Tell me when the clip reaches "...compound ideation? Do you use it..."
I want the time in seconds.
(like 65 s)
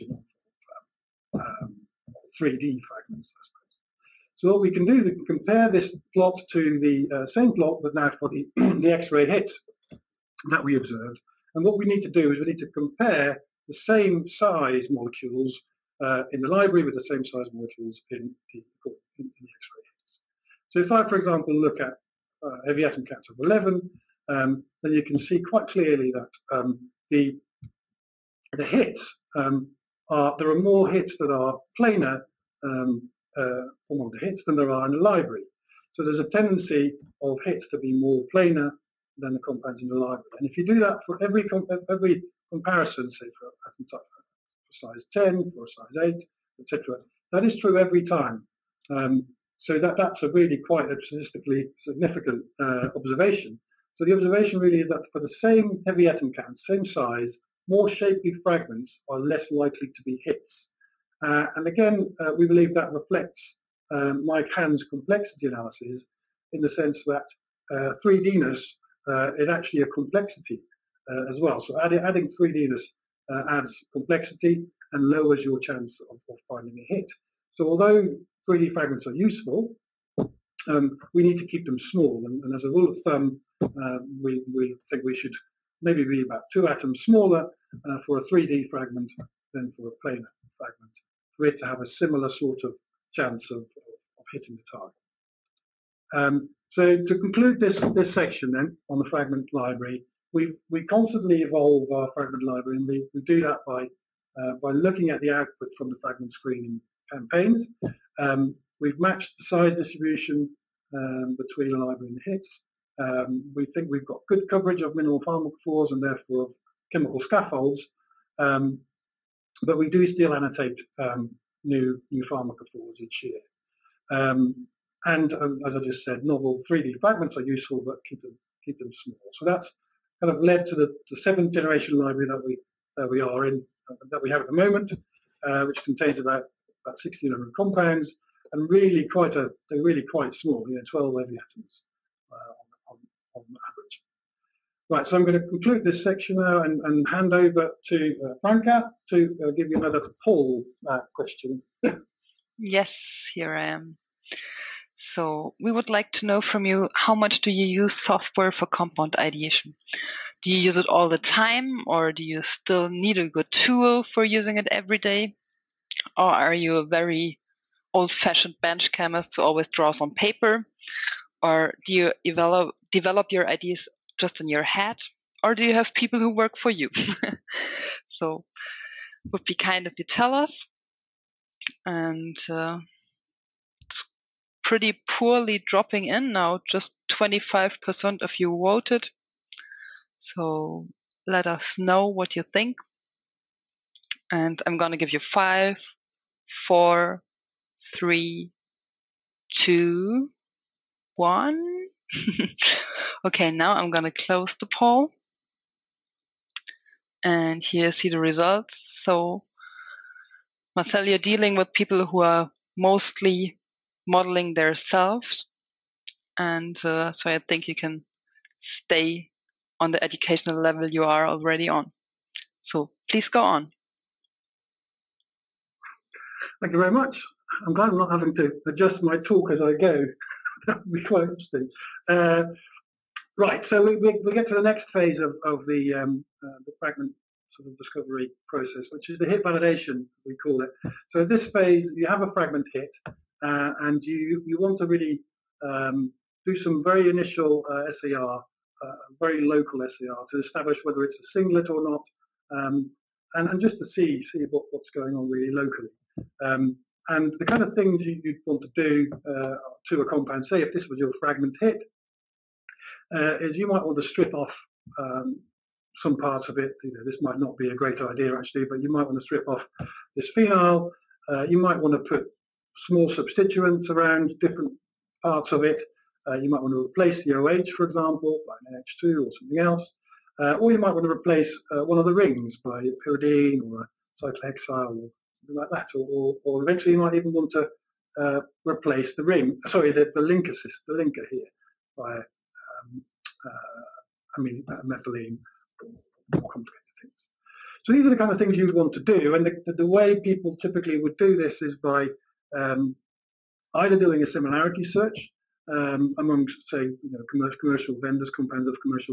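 158 s.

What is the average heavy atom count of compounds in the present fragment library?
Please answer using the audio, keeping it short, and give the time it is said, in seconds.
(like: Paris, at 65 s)
12, at 140 s.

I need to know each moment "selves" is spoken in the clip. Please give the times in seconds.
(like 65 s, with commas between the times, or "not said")
214 s.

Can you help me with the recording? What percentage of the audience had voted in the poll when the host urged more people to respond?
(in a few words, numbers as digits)
25%.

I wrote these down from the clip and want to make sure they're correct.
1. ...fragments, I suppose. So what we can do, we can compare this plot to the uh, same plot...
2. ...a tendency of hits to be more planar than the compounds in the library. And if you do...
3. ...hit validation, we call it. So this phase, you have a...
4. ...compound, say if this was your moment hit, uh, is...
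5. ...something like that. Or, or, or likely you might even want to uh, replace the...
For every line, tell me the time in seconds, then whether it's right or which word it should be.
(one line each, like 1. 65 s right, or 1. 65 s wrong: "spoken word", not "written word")
1. 2 s right
2. 36 s right
3. 239 s right
4. 260 s wrong: "fragment", not "moment"
5. 285 s wrong: "eventually", not "likely".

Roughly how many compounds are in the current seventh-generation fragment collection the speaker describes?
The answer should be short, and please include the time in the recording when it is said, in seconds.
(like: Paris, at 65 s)
1600, at 137 s.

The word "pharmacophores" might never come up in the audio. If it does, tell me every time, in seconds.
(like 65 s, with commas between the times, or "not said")
115 s, 122 s.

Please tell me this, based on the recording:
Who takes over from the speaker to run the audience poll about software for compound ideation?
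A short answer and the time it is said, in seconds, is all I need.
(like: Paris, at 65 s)
Franca, at 148 s.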